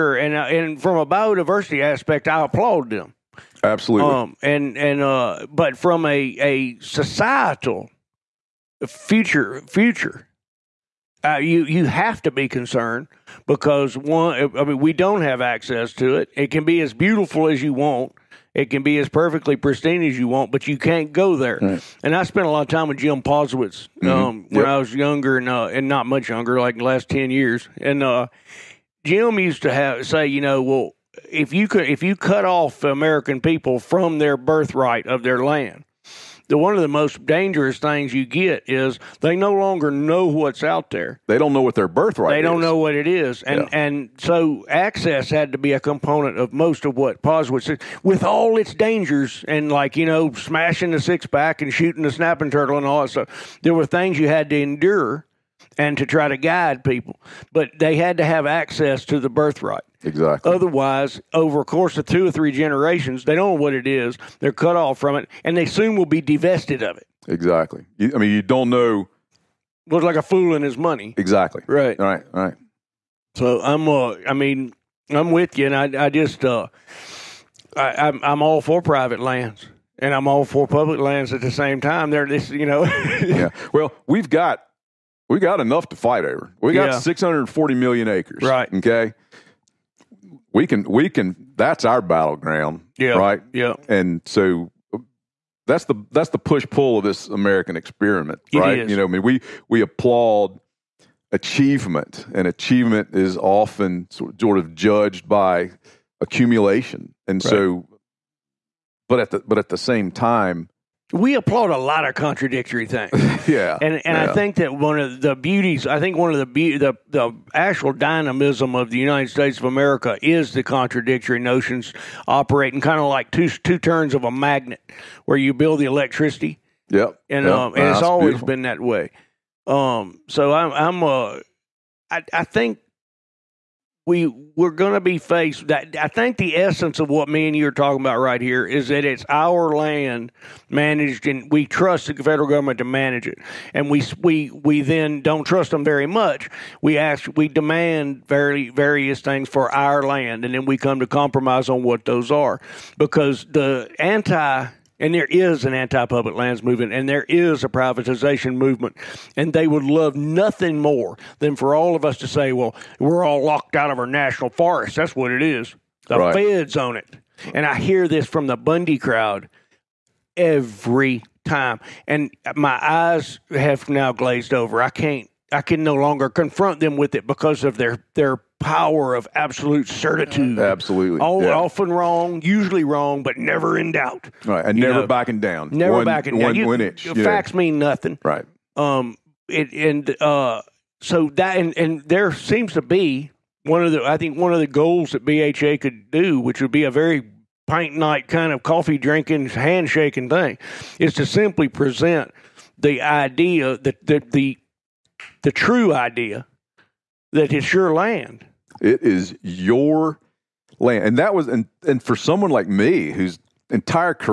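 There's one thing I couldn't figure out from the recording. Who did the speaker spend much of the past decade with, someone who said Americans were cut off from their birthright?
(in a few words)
Jim Posewitz.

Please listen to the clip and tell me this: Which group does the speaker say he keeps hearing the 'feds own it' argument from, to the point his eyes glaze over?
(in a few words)
the Bundy crowd.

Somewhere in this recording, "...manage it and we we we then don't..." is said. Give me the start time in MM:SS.
02:22.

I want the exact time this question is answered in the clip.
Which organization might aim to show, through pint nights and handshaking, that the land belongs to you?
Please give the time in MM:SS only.
03:15.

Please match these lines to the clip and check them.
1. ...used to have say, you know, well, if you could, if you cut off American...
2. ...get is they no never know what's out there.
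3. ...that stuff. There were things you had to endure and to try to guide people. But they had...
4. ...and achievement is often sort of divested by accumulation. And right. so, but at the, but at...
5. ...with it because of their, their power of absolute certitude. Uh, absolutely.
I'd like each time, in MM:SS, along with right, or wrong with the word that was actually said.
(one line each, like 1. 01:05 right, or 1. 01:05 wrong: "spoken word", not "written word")
1. 00:29 right
2. 00:38 wrong: "longer", not "never"
3. 00:53 right
4. 01:42 wrong: "judged", not "divested"
5. 02:56 right.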